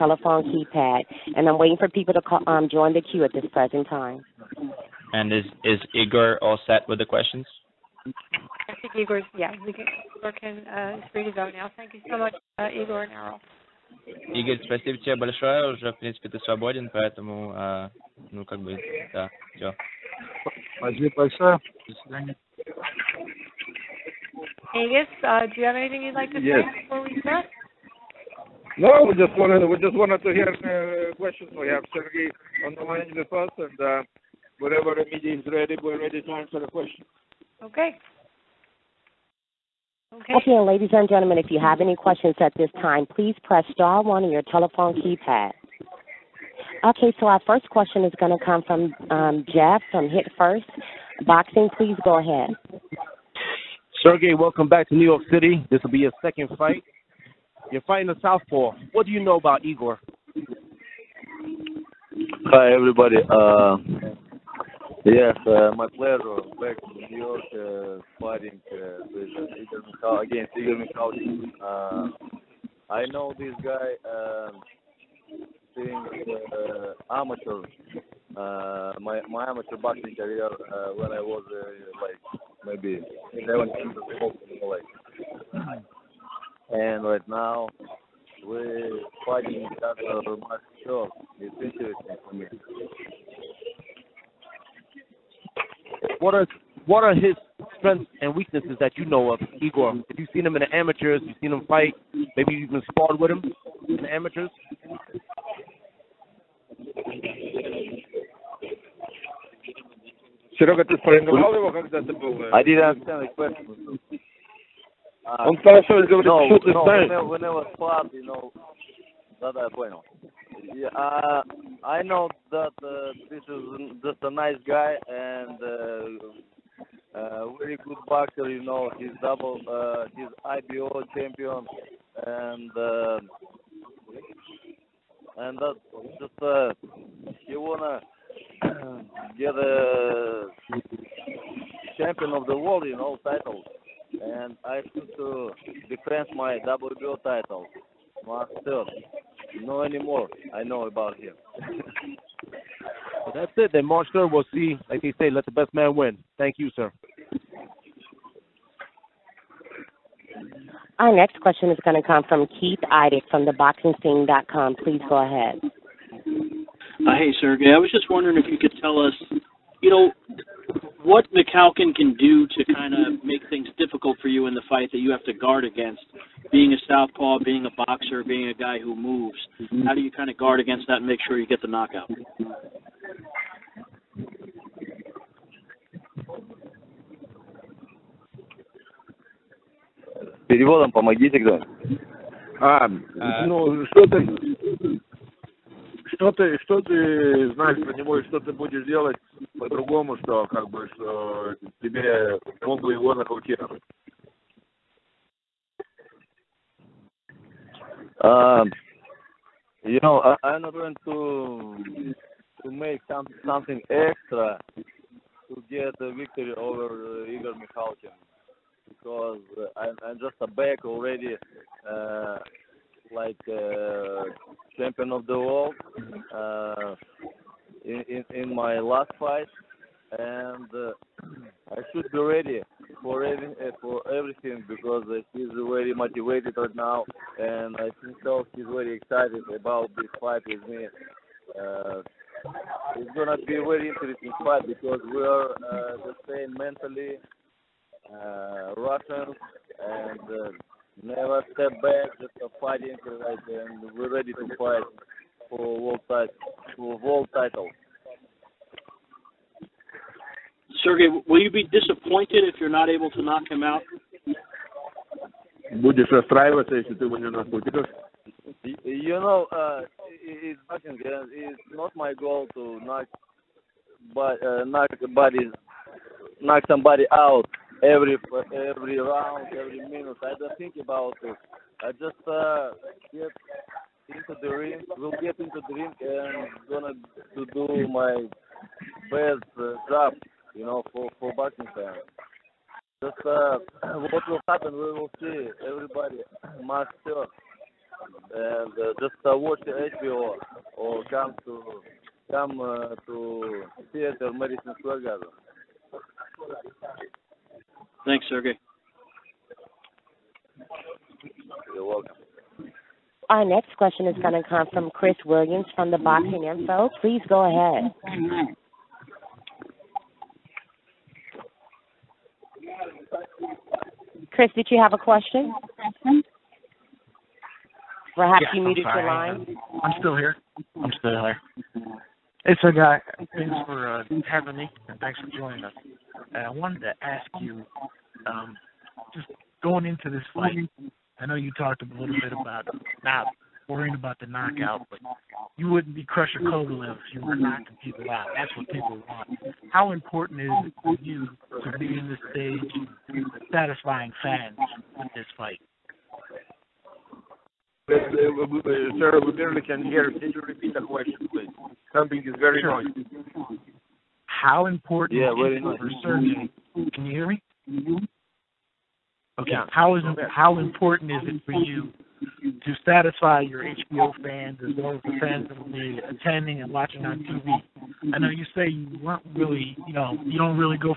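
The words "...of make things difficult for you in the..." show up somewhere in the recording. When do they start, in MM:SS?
02:52.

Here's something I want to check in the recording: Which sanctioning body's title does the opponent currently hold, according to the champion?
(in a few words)
IBO.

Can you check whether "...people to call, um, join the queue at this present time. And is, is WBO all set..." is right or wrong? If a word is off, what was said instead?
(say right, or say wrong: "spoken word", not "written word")
wrong: "Igor", not "WBO".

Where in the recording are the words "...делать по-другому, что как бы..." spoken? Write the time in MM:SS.
03:18.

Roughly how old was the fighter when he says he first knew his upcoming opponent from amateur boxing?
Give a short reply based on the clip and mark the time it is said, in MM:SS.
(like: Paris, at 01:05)
11, at 01:23.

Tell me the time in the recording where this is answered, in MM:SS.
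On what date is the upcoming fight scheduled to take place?
02:33.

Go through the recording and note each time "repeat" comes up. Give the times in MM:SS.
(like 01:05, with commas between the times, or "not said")
06:00.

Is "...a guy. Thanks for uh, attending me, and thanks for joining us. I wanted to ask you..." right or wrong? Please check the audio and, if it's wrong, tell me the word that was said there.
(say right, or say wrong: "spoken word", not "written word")
wrong: "having", not "attending".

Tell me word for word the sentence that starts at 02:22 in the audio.
You know, title, and I need to defend my WBO title, master.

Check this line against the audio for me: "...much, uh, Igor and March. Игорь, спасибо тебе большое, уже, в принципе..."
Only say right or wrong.
wrong.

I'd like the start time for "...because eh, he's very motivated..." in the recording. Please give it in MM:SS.
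03:54.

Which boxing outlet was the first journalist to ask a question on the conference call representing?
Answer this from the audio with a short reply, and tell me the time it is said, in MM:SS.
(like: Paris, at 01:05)
Hit First Boxing, at 00:50.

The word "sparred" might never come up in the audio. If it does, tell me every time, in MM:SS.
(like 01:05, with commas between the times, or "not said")
01:42, 01:57.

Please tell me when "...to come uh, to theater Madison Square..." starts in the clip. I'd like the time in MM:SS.
05:01.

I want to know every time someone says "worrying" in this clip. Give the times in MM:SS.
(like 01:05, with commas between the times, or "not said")
05:43.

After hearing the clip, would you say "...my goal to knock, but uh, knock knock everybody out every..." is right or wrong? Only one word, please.
wrong.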